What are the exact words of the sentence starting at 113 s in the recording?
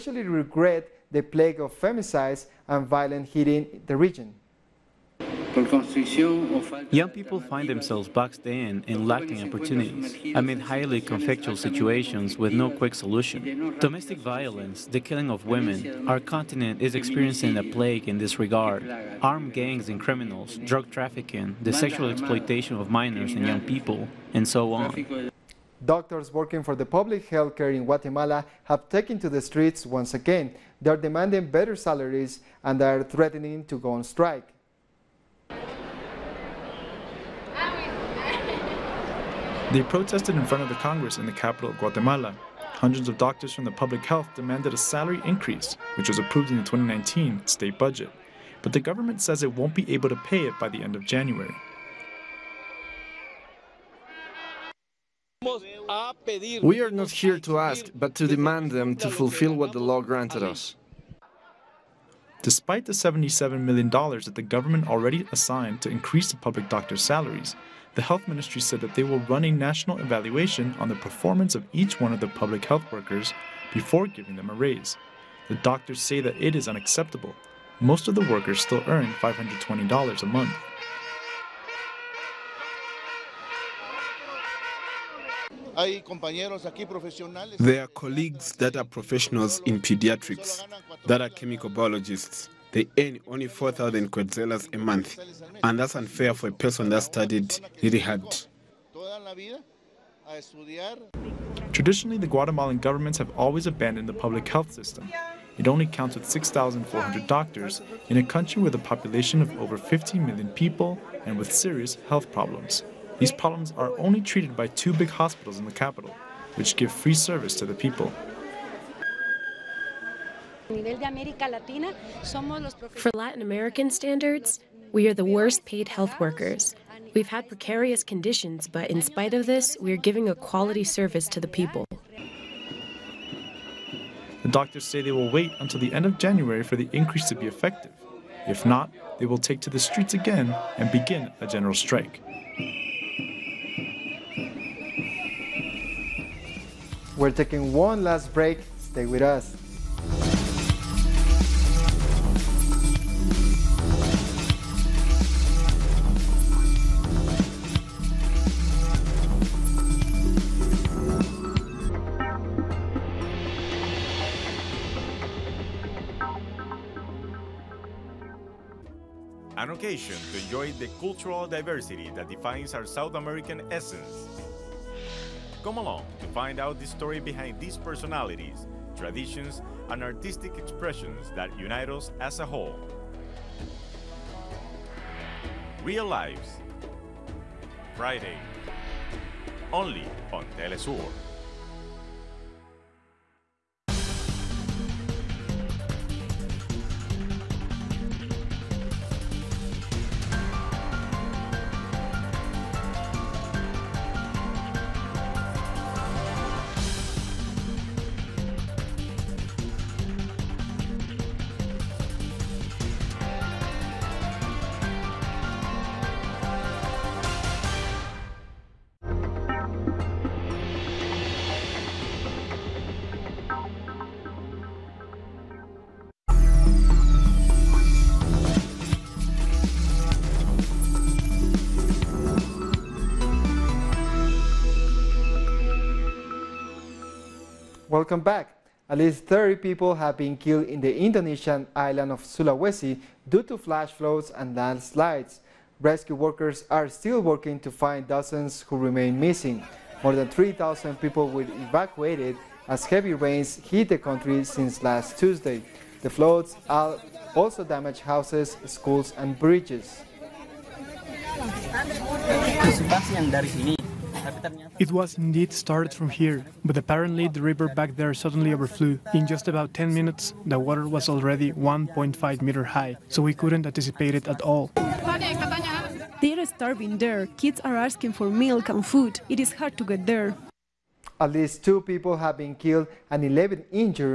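These problems are only treated by two big hospitals in the capital, which give free service to the people.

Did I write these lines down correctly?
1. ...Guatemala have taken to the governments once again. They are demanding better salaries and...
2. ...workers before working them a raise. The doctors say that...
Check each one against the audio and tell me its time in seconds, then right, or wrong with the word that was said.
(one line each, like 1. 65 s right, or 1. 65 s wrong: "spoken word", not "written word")
1. 27 s wrong: "streets", not "governments"
2. 72 s wrong: "giving", not "working".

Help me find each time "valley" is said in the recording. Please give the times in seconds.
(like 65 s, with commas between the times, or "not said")
not said.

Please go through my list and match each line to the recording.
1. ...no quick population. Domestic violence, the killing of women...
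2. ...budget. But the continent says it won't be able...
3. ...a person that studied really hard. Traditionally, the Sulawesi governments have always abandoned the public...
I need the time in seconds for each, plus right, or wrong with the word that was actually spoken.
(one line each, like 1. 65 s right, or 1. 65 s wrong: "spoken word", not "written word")
1. 12 s wrong: "solution", not "population"
2. 47 s wrong: "government", not "continent"
3. 96 s wrong: "Guatemalan", not "Sulawesi".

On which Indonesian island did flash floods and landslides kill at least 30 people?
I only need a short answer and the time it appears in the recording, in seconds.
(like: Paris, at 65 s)
Sulawesi, at 242 s.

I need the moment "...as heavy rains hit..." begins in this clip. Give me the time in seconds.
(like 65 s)
252 s.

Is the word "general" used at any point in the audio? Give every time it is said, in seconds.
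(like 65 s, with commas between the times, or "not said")
141 s.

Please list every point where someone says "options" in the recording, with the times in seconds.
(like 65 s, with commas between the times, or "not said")
not said.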